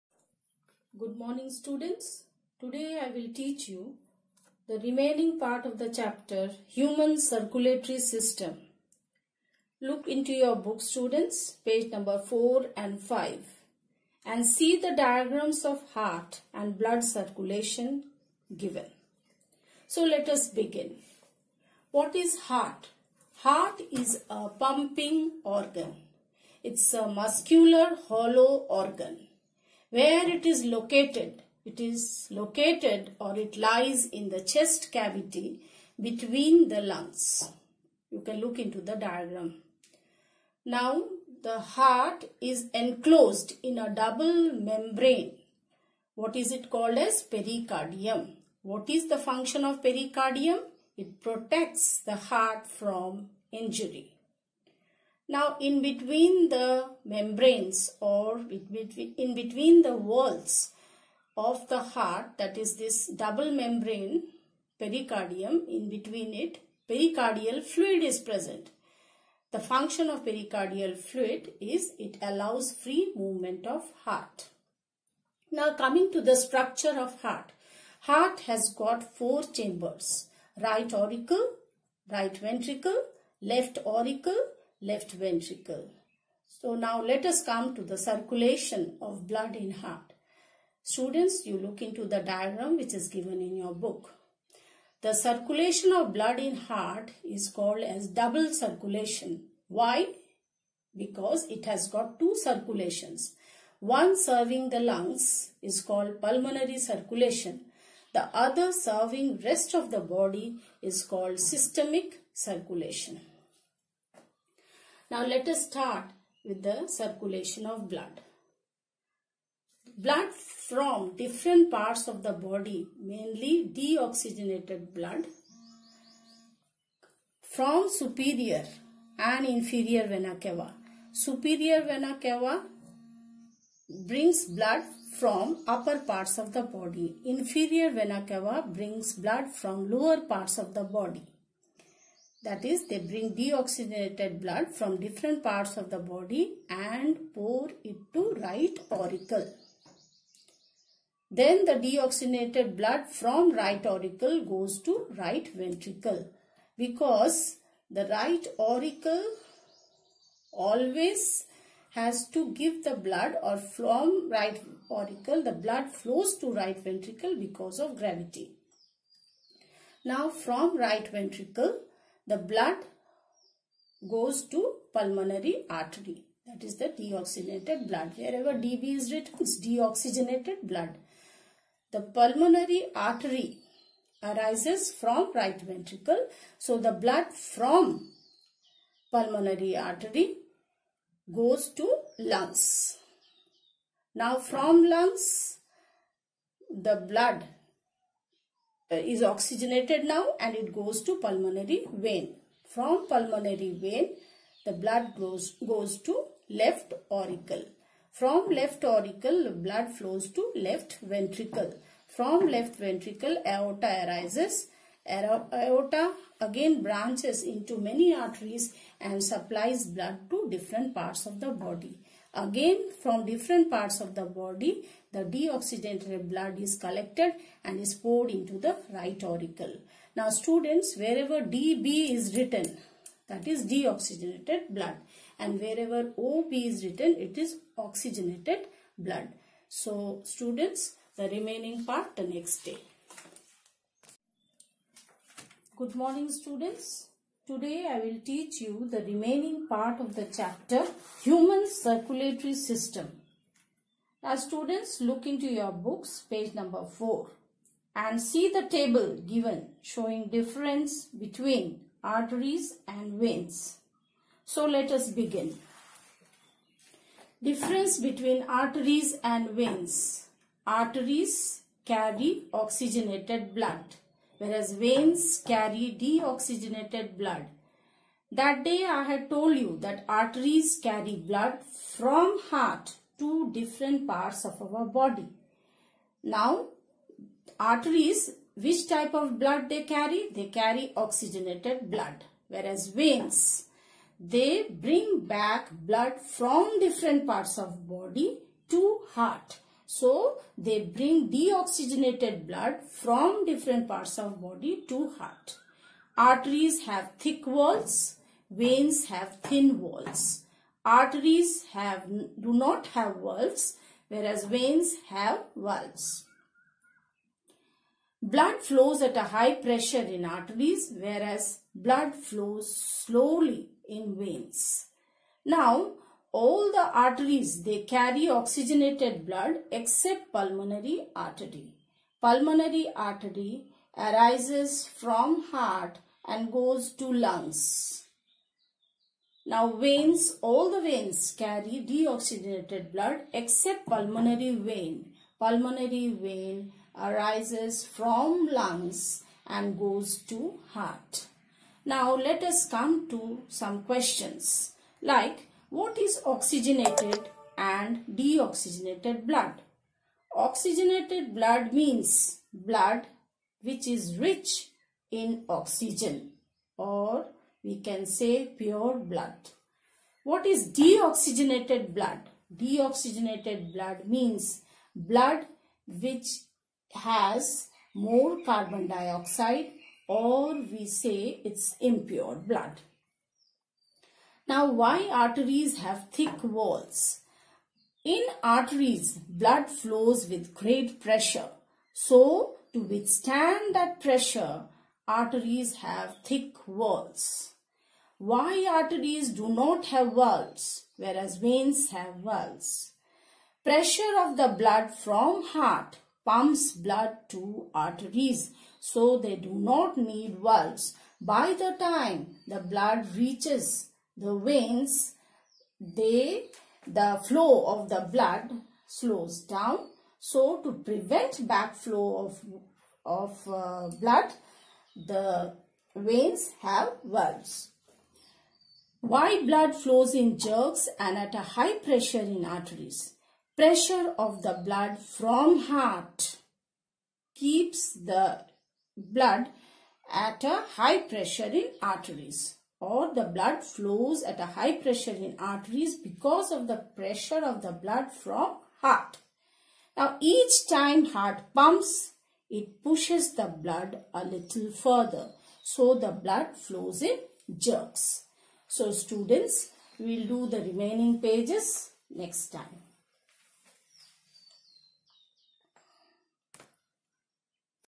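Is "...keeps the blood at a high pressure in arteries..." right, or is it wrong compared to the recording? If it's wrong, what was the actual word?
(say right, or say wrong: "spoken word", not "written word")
right.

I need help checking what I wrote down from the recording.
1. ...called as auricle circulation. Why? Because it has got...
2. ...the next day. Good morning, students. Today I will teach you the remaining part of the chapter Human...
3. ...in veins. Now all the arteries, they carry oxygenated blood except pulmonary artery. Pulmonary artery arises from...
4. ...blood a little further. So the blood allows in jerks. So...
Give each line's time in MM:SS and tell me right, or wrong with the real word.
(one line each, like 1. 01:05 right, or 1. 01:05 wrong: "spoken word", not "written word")
1. 01:37 wrong: "double", not "auricle"
2. 04:02 right
3. 05:23 right
4. 07:33 wrong: "flows", not "allows".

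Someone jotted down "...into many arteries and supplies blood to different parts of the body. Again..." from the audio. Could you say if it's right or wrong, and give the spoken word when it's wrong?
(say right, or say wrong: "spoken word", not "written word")
right.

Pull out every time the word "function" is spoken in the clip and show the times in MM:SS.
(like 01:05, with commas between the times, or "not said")
00:49, 01:09.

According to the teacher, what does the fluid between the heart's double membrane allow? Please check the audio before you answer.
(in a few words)
Free movement of heart.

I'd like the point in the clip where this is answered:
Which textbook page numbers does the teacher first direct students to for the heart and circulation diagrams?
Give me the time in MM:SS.
00:11.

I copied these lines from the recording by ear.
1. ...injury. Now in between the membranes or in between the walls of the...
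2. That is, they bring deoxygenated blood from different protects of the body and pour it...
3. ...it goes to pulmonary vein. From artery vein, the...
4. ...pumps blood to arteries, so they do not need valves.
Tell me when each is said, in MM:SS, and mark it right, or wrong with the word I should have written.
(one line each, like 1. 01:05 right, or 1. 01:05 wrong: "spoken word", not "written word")
1. 00:53 right
2. 02:22 wrong: "parts", not "protects"
3. 03:20 wrong: "pulmonary", not "artery"
4. 06:46 right.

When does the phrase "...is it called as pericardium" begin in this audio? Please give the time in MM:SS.
00:46.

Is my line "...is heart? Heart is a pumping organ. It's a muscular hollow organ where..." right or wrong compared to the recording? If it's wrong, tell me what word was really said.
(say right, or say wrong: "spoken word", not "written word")
right.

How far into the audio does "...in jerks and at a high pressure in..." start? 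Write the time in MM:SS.
07:10.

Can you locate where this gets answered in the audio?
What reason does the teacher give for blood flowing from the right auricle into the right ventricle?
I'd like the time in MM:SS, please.
02:47.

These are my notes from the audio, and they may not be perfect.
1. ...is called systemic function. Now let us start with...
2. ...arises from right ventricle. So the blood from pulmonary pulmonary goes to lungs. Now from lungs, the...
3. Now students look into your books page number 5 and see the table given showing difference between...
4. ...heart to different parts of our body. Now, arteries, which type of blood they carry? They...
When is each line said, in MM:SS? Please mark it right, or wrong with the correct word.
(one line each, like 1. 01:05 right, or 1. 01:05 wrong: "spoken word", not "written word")
1. 01:50 wrong: "circulation", not "function"
2. 03:04 wrong: "artery", not "pulmonary"
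3. 04:14 wrong: "4", not "5"
4. 04:42 right.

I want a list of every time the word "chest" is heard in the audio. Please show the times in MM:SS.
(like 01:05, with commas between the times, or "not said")
00:34.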